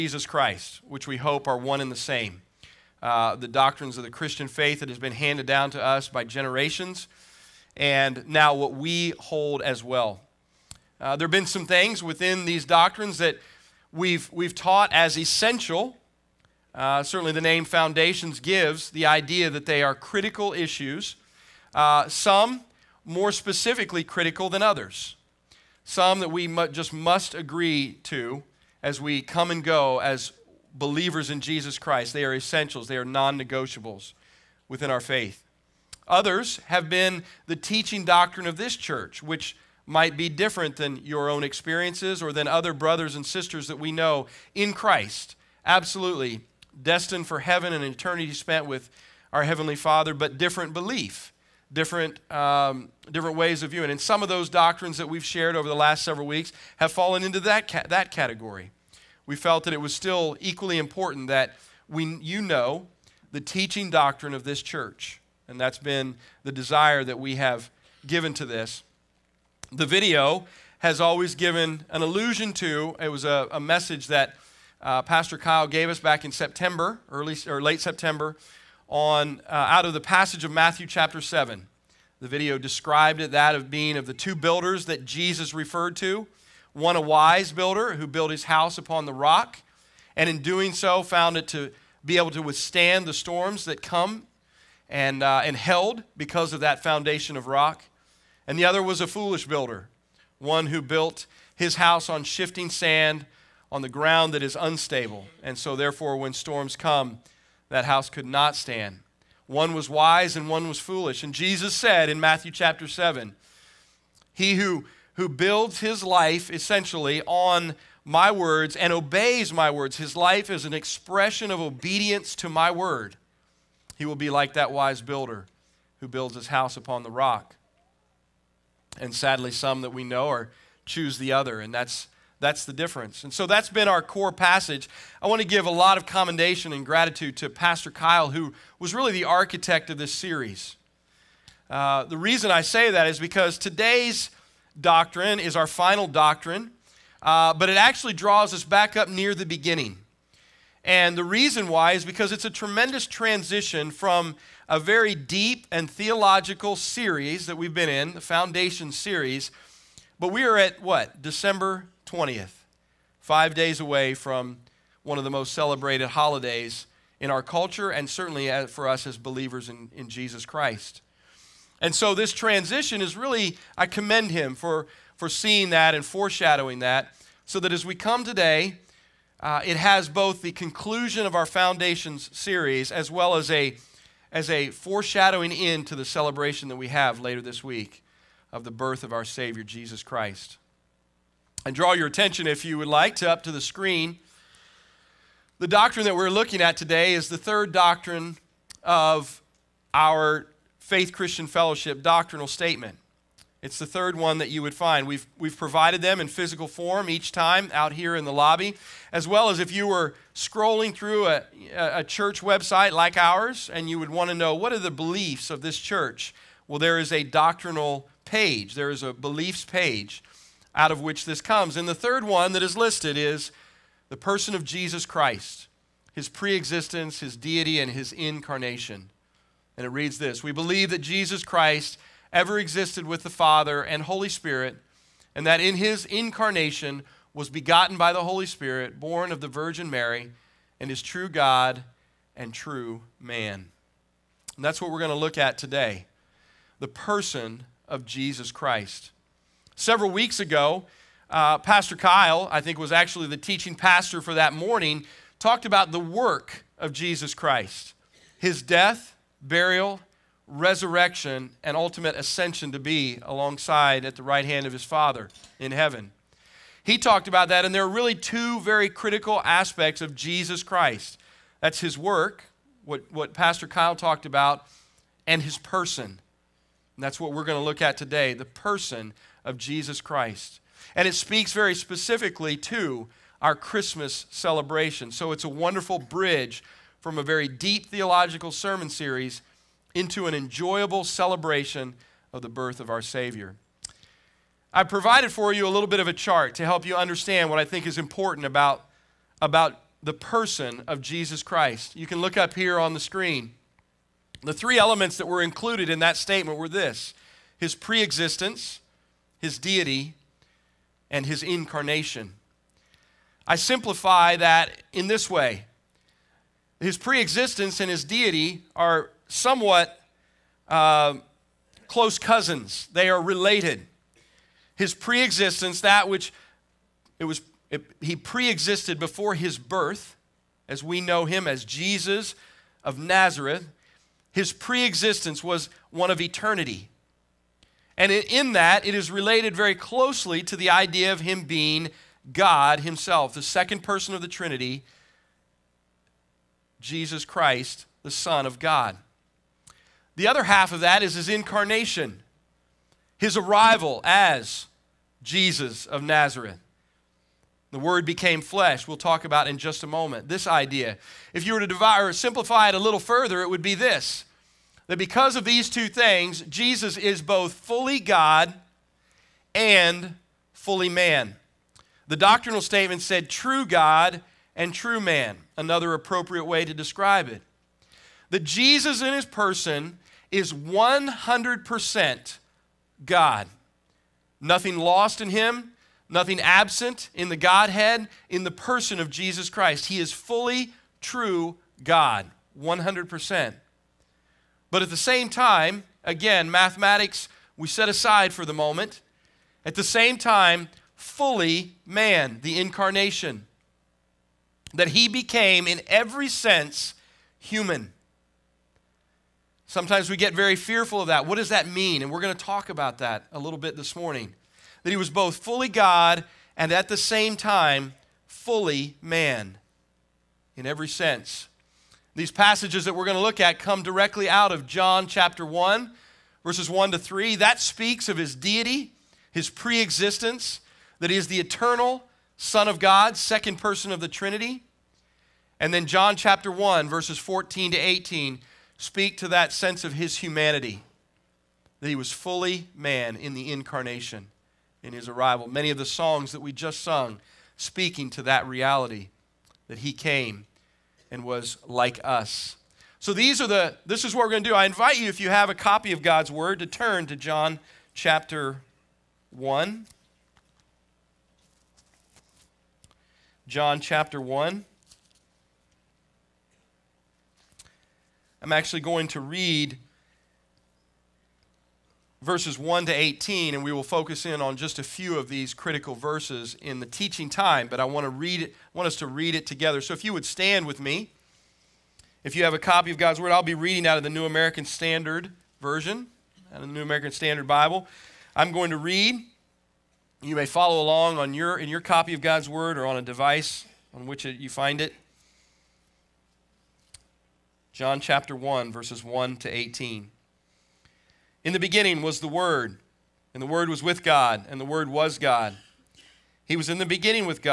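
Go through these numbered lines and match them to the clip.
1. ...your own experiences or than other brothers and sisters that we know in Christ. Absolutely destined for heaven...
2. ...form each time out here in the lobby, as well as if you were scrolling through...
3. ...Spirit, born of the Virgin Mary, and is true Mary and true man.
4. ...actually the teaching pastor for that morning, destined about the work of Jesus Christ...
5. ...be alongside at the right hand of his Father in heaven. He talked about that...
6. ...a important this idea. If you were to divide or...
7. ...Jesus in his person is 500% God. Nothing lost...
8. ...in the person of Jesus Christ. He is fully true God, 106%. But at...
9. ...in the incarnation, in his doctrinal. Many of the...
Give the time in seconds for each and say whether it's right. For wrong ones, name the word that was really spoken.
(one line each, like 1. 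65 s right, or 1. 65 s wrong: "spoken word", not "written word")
1. 41 s right
2. 206 s right
3. 238 s wrong: "God", not "Mary"
4. 252 s wrong: "talked", not "destined"
5. 262 s right
6. 359 s wrong: "moment", not "important"
7. 378 s wrong: "100", not "500"
8. 388 s wrong: "100", not "106"
9. 443 s wrong: "arrival", not "doctrinal".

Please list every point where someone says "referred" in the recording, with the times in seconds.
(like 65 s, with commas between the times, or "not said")
85 s.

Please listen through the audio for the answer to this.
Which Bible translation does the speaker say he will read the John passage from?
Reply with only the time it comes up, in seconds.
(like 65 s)
486 s.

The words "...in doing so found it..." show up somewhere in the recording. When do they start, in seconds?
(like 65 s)
90 s.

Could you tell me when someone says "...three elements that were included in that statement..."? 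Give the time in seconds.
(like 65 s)
304 s.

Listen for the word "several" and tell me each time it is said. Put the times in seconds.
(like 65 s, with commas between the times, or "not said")
56 s, 249 s.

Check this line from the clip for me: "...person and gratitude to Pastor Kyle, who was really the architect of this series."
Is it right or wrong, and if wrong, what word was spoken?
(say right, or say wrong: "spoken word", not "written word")
wrong: "commendation", not "person".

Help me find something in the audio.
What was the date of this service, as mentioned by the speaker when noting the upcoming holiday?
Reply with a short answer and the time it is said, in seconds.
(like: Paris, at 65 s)
December 20th, at 161 s.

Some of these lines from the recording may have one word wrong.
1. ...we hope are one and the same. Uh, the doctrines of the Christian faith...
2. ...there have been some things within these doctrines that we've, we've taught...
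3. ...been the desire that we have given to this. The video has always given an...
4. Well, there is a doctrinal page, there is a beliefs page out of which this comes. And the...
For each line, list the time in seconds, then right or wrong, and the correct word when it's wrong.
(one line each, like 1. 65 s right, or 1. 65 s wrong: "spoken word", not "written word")
1. 1 s right
2. 11 s right
3. 65 s right
4. 216 s right.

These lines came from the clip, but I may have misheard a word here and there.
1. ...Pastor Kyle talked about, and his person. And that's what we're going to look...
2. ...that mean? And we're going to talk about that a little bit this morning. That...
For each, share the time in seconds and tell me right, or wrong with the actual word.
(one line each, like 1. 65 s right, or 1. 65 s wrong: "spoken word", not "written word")
1. 273 s right
2. 411 s right.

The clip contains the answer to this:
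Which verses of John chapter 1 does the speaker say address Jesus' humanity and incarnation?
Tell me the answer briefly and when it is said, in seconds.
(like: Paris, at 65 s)
14 to 18, at 436 s.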